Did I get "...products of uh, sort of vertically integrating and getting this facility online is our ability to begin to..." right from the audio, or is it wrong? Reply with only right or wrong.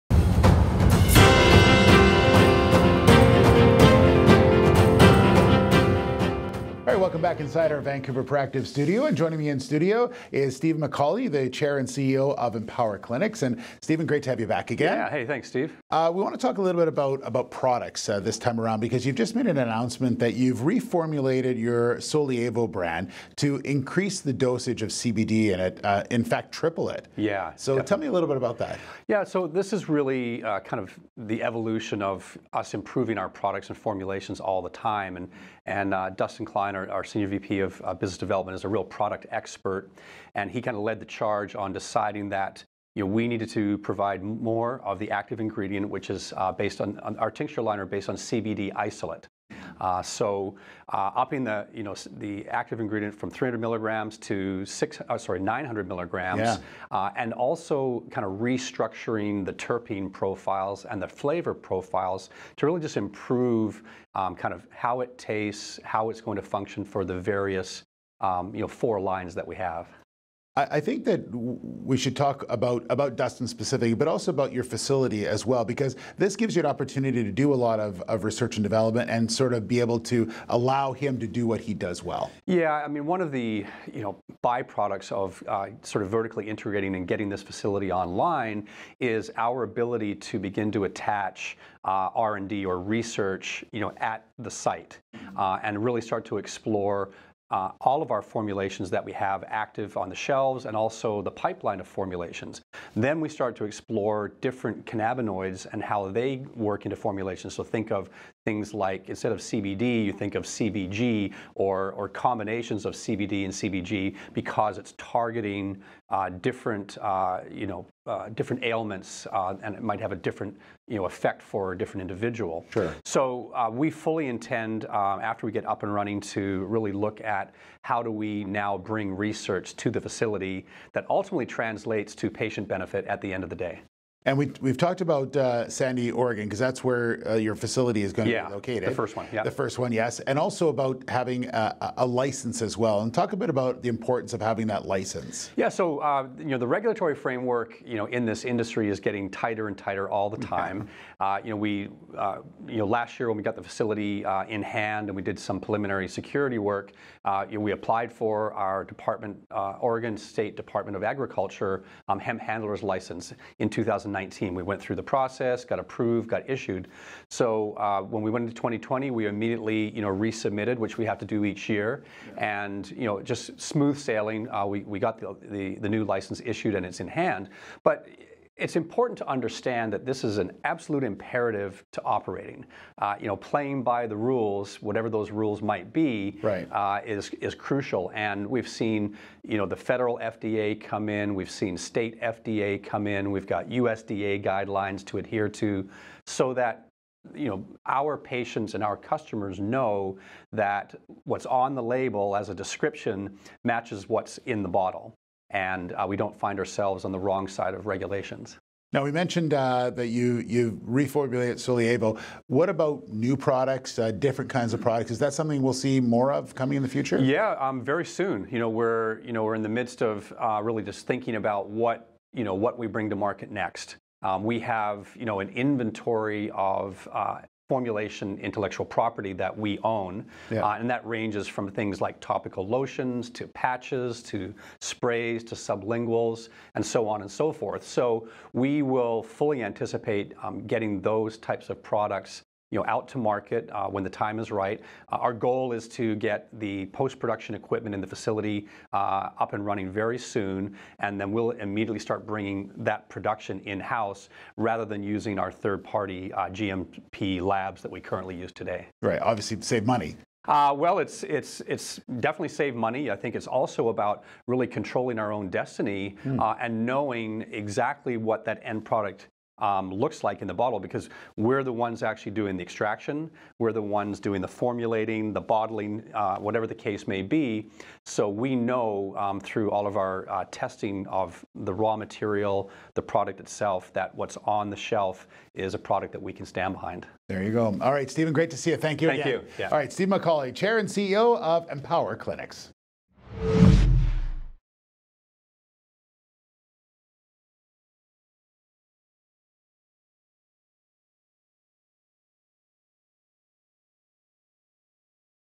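wrong.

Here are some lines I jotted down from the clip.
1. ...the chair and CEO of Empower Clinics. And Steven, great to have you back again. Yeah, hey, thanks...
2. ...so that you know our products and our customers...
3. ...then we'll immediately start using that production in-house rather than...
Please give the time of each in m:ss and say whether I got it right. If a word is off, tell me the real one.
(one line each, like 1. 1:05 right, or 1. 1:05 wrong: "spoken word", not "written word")
1. 0:11 right
2. 3:16 wrong: "patients", not "products"
3. 4:11 wrong: "bringing", not "using".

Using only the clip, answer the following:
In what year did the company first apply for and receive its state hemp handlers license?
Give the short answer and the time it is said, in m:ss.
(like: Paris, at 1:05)
2019, at 2:44.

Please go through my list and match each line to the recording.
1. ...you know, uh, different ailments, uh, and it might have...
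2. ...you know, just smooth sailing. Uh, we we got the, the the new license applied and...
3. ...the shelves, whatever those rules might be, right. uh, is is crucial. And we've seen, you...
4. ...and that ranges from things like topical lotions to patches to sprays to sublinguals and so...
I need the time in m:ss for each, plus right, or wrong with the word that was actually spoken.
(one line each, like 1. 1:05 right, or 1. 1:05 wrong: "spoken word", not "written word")
1. 1:57 right
2. 2:52 wrong: "issued", not "applied"
3. 3:04 wrong: "rules", not "shelves"
4. 3:50 right.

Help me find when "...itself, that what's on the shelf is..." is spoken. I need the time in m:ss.
4:43.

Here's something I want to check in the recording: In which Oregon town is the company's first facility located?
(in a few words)
Sandy, Oregon.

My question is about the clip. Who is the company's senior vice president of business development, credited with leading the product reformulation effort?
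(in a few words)
Dustin Kleiner.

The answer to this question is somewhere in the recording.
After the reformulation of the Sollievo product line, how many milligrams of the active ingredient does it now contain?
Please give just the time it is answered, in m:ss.
0:55.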